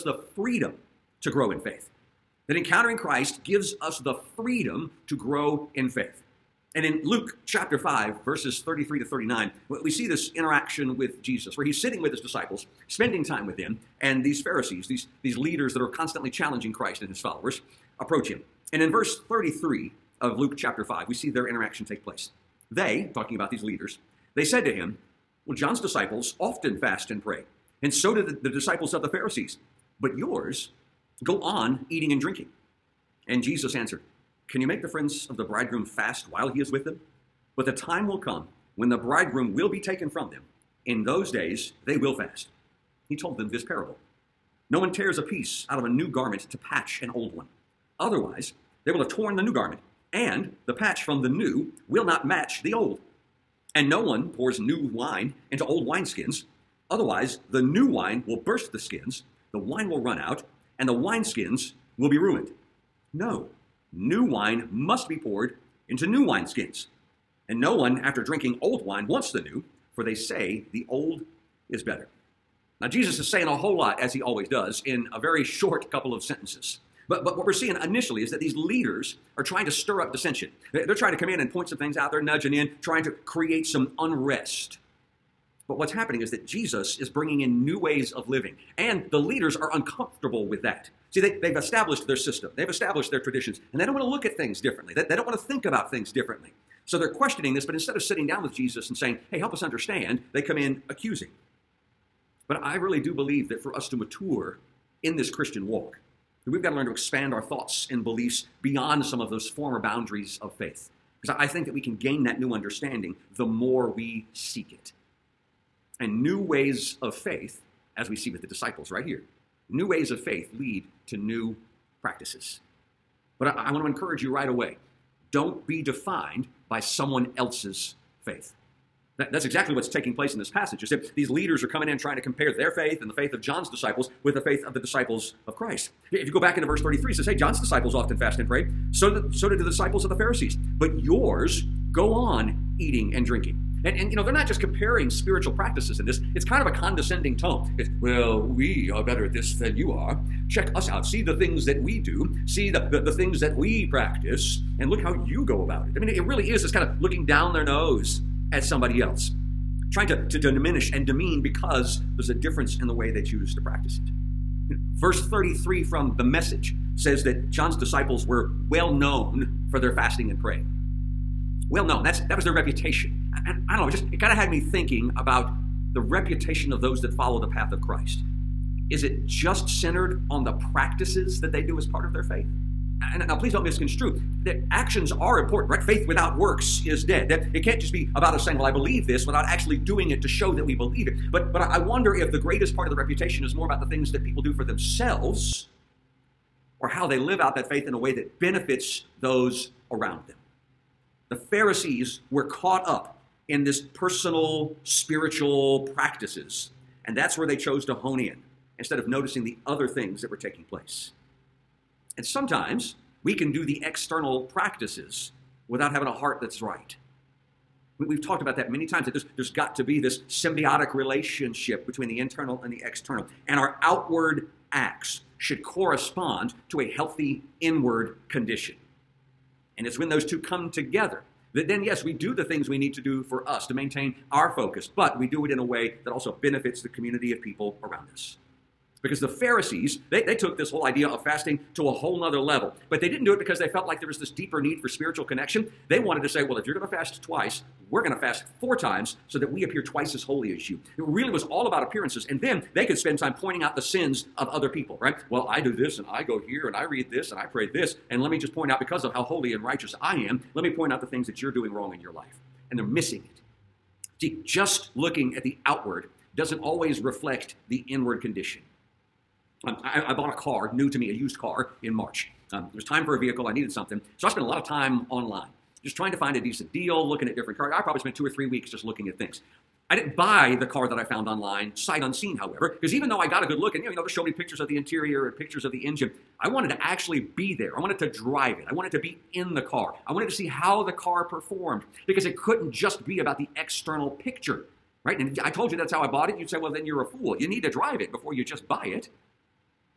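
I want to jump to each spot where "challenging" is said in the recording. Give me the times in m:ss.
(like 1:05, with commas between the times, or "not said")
0:16.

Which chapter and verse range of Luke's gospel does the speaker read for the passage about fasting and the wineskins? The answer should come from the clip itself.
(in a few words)
Chapter 5, verses 33 to 39.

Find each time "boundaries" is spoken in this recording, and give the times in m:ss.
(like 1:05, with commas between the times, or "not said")
1:49.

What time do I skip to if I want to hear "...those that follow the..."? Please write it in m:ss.
2:56.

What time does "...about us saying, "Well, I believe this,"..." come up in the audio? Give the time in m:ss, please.
3:08.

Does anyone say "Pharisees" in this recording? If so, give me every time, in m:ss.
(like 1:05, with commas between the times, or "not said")
0:14, 0:29, 2:20, 3:21, 3:59.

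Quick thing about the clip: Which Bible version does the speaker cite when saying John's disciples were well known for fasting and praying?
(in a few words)
The Message.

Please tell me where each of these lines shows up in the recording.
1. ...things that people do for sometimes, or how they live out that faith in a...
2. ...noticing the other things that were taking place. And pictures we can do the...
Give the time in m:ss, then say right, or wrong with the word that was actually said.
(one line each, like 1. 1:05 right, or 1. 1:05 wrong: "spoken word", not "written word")
1. 3:13 wrong: "themselves", not "sometimes"
2. 3:29 wrong: "sometimes", not "pictures".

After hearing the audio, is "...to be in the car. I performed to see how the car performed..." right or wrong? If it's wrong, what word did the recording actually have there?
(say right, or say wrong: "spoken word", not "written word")
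wrong: "wanted", not "performed".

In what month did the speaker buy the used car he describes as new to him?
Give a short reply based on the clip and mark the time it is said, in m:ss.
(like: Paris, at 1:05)
March, at 4:31.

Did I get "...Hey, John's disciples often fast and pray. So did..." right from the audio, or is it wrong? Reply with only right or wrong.
right.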